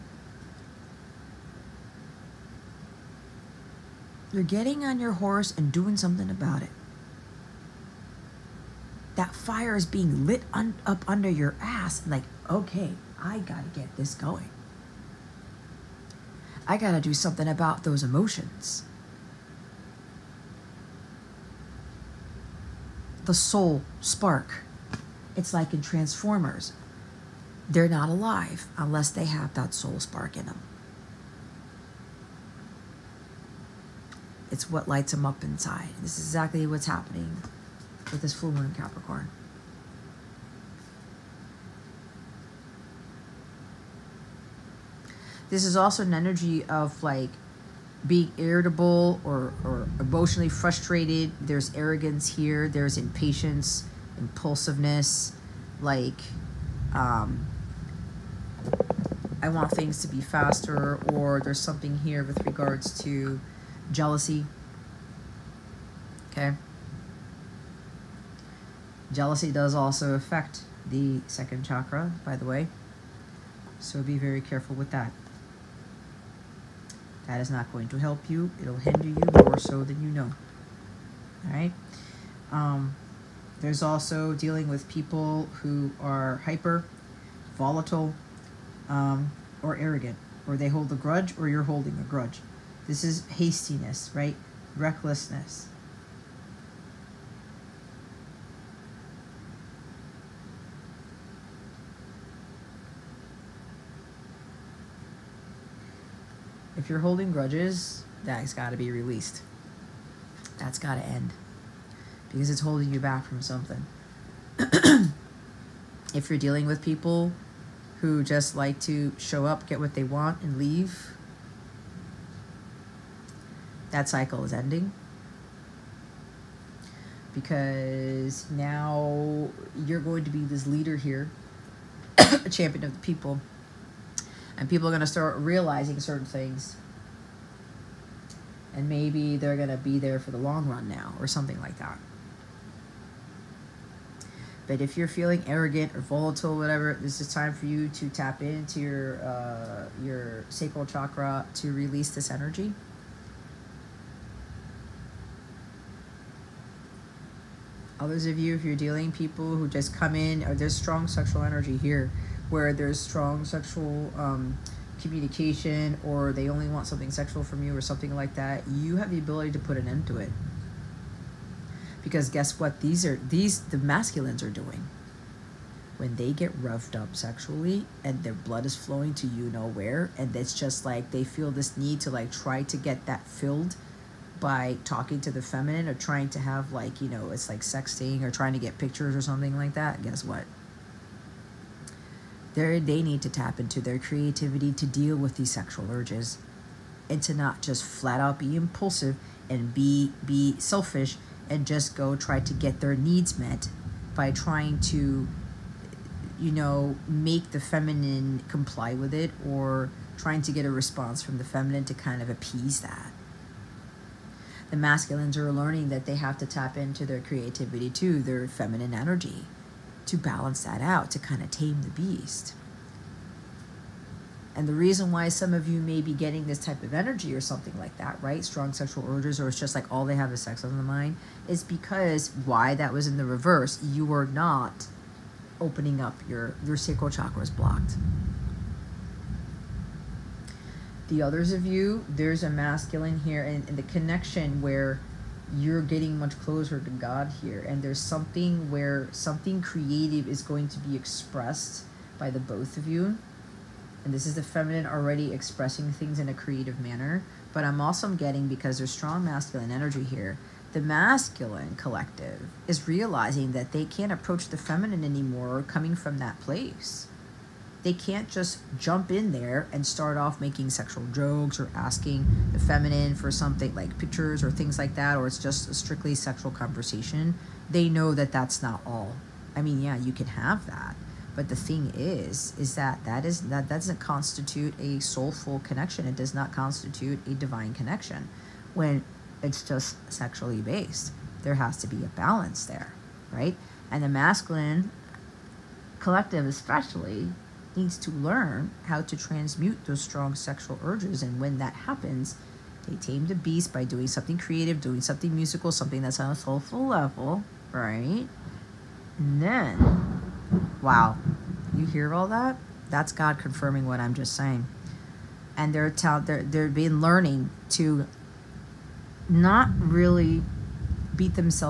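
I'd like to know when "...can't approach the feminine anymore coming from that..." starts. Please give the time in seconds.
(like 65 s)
263 s.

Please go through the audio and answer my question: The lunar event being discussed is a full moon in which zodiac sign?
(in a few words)
Capricorn.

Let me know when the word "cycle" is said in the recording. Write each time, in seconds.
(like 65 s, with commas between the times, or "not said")
124 s.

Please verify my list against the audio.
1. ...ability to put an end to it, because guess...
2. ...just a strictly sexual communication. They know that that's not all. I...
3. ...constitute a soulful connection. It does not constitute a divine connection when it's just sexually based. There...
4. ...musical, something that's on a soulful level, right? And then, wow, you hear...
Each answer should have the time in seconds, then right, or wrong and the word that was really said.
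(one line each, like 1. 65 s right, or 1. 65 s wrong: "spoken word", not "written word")
1. 169 s right
2. 275 s wrong: "conversation", not "communication"
3. 283 s right
4. 305 s right.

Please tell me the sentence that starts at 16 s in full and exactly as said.
I gotta do something about those emotions.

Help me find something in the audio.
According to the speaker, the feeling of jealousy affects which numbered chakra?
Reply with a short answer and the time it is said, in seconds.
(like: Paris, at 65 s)
second chakra, at 71 s.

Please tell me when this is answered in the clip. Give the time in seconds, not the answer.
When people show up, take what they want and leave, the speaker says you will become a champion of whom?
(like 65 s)
132 s.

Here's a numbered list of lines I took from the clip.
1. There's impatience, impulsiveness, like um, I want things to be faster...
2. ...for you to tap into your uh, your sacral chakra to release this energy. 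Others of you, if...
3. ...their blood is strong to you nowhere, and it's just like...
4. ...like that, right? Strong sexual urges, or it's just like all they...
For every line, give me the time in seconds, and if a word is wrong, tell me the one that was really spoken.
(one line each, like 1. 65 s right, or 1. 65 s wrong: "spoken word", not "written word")
1. 52 s right
2. 147 s right
3. 178 s wrong: "flowing", not "strong"
4. 227 s right.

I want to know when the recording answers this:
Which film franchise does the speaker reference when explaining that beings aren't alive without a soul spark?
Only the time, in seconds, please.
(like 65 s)
25 s.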